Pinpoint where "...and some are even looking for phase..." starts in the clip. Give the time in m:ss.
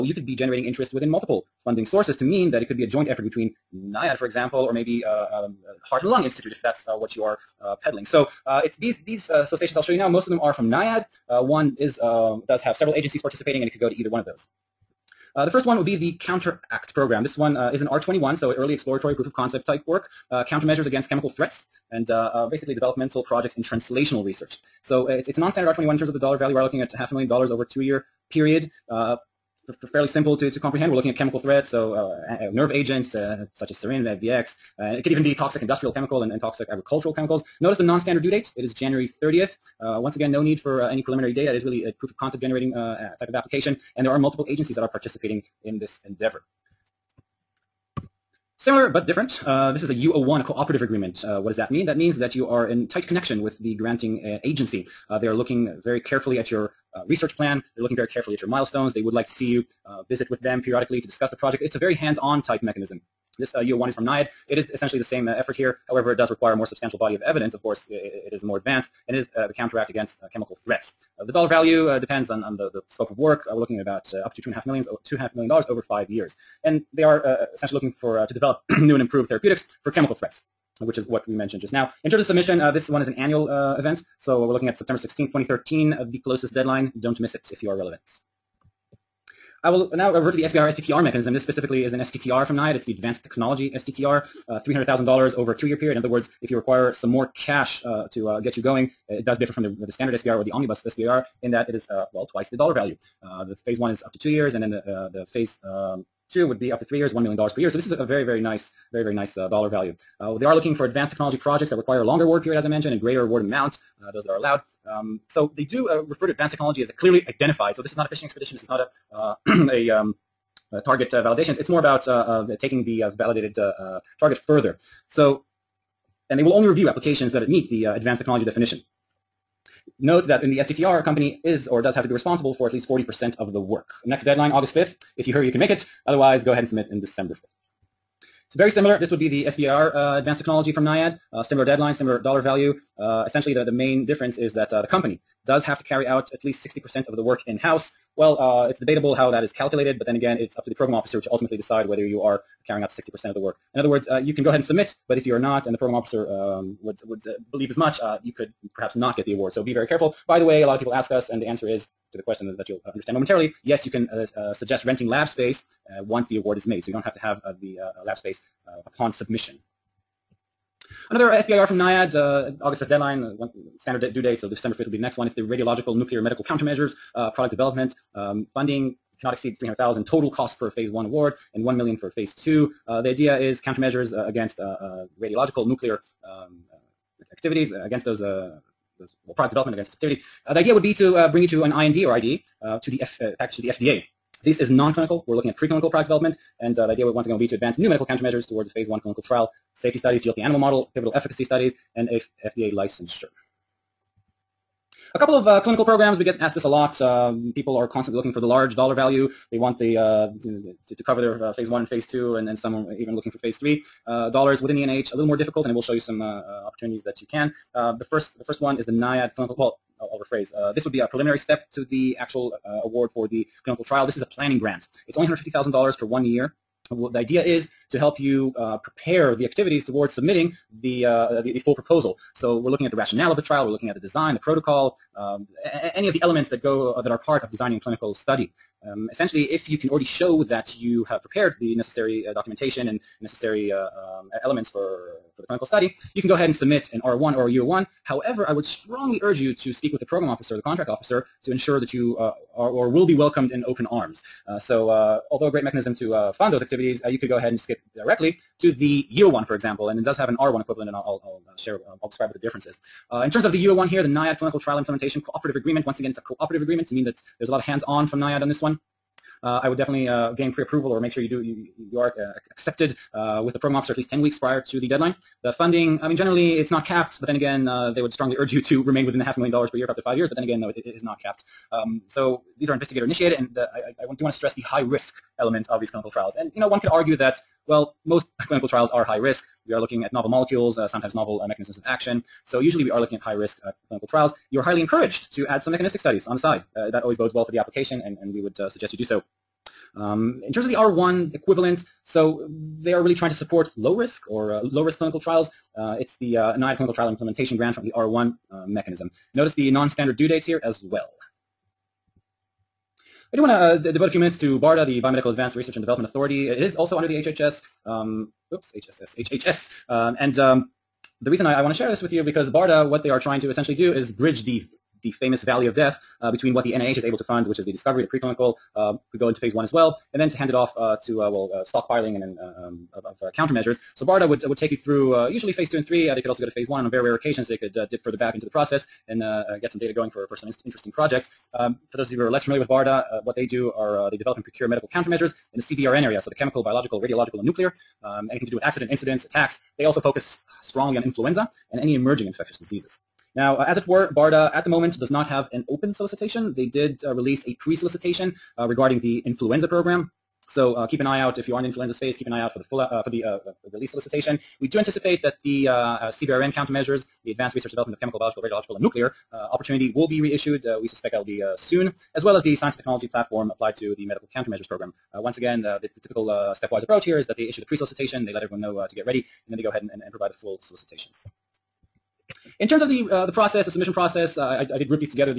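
3:32.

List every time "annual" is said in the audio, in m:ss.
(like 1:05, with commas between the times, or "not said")
1:23.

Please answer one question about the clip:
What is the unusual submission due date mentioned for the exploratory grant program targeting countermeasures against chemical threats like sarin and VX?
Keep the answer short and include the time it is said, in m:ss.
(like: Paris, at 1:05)
January 30th, at 0:38.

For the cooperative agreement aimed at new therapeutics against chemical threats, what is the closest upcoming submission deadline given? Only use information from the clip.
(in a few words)
September 16, 2013.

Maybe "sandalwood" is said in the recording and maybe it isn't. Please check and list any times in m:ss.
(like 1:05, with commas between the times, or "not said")
not said.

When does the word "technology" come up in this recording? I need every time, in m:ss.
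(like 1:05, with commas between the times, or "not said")
1:33, 1:51, 1:56, 2:08, 2:20, 6:12.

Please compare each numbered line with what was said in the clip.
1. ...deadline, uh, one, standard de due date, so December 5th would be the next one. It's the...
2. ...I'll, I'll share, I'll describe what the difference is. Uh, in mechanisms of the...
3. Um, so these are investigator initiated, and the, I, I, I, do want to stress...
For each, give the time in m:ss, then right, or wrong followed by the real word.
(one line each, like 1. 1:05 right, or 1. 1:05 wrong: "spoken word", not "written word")
1. 2:52 right
2. 4:21 wrong: "terms", not "mechanisms"
3. 4:41 right.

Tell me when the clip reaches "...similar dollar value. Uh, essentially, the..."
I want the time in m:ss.
2:21.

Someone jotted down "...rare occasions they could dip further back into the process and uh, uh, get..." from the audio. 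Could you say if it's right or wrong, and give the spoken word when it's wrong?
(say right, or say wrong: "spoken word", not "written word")
right.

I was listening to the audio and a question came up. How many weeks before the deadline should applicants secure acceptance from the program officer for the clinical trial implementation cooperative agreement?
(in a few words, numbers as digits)
10 weeks.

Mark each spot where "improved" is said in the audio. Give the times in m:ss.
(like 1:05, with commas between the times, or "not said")
1:19.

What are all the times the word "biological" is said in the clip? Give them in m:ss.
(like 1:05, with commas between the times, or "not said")
5:46, 6:08.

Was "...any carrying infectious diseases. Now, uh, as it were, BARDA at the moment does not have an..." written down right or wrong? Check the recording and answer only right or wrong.
wrong.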